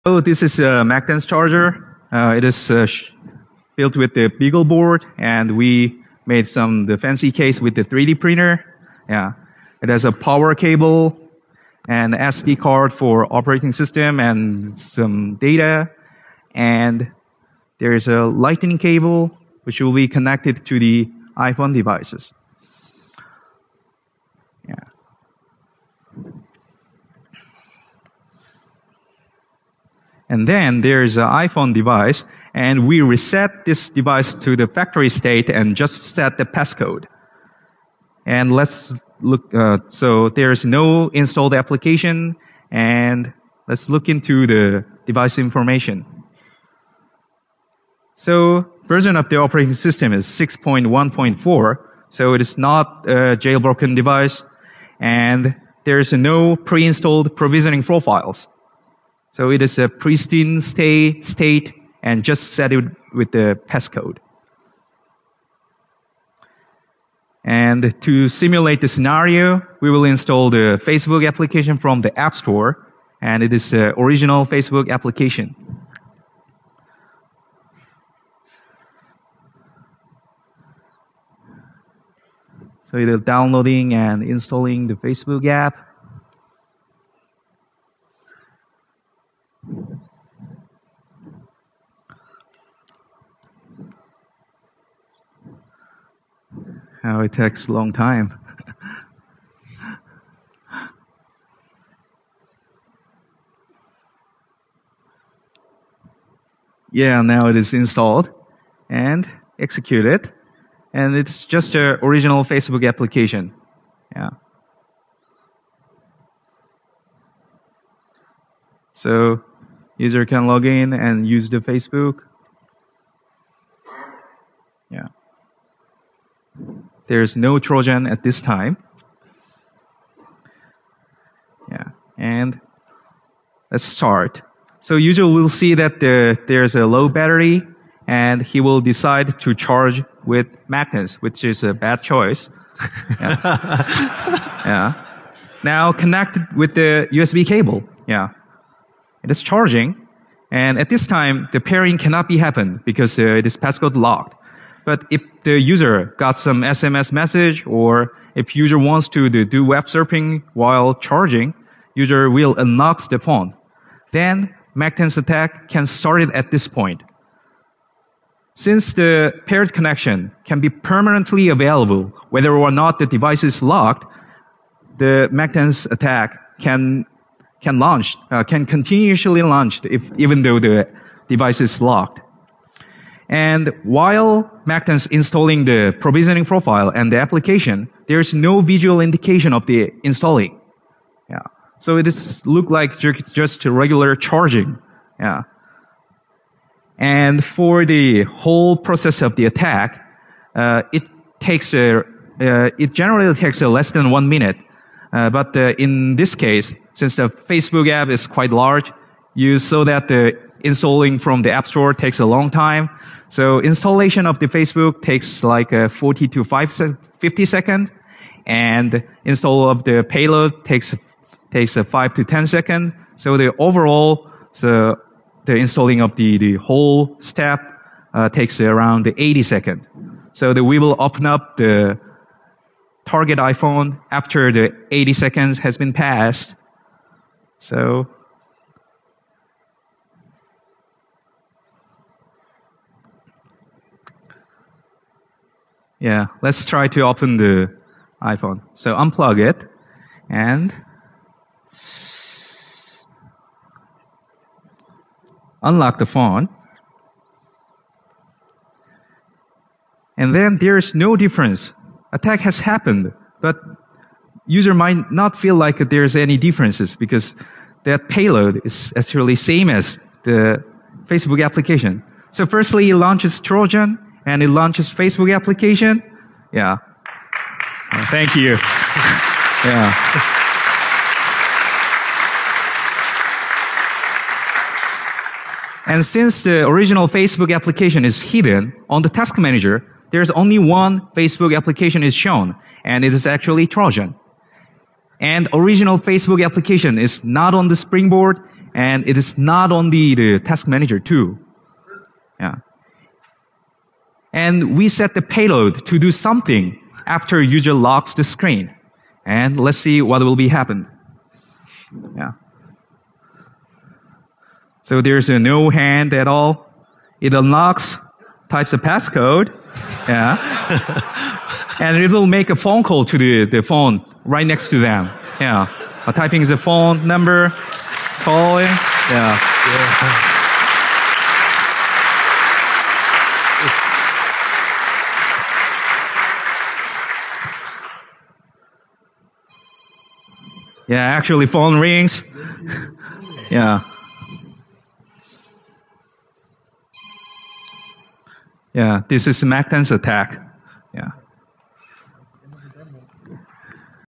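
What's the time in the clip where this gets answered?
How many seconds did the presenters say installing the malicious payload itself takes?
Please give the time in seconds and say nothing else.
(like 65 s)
221 s.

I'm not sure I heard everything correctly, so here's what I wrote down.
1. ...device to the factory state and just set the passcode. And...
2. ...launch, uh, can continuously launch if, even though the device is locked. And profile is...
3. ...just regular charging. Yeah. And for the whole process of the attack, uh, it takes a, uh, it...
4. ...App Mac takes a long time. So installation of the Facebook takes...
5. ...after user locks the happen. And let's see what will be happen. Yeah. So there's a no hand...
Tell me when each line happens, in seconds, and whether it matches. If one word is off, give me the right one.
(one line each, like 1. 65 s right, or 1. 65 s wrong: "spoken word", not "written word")
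1. 33 s right
2. 177 s wrong: "while", not "profile"
3. 193 s right
4. 211 s wrong: "Store", not "Mac"
5. 307 s wrong: "screen", not "happen".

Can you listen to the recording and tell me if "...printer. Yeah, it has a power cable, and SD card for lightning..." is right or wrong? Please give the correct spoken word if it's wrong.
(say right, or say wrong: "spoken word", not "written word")
wrong: "operating", not "lightning".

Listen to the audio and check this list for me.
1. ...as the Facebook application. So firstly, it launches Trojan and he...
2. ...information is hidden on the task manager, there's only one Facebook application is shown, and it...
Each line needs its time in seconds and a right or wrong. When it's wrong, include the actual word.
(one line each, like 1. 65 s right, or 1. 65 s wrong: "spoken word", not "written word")
1. 269 s right
2. 287 s wrong: "application", not "information".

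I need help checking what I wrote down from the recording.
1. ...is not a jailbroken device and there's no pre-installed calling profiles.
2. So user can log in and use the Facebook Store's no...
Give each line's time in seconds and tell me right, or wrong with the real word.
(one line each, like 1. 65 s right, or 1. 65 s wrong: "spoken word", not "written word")
1. 52 s wrong: "provisioning", not "calling"
2. 118 s wrong: "There", not "Store".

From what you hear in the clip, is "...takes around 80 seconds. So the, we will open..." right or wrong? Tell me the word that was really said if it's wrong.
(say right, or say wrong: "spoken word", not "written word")
right.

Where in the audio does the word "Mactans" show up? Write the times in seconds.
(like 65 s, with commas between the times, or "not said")
0 s, 140 s.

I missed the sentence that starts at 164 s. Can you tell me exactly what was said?
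Then mac attack can start at this point.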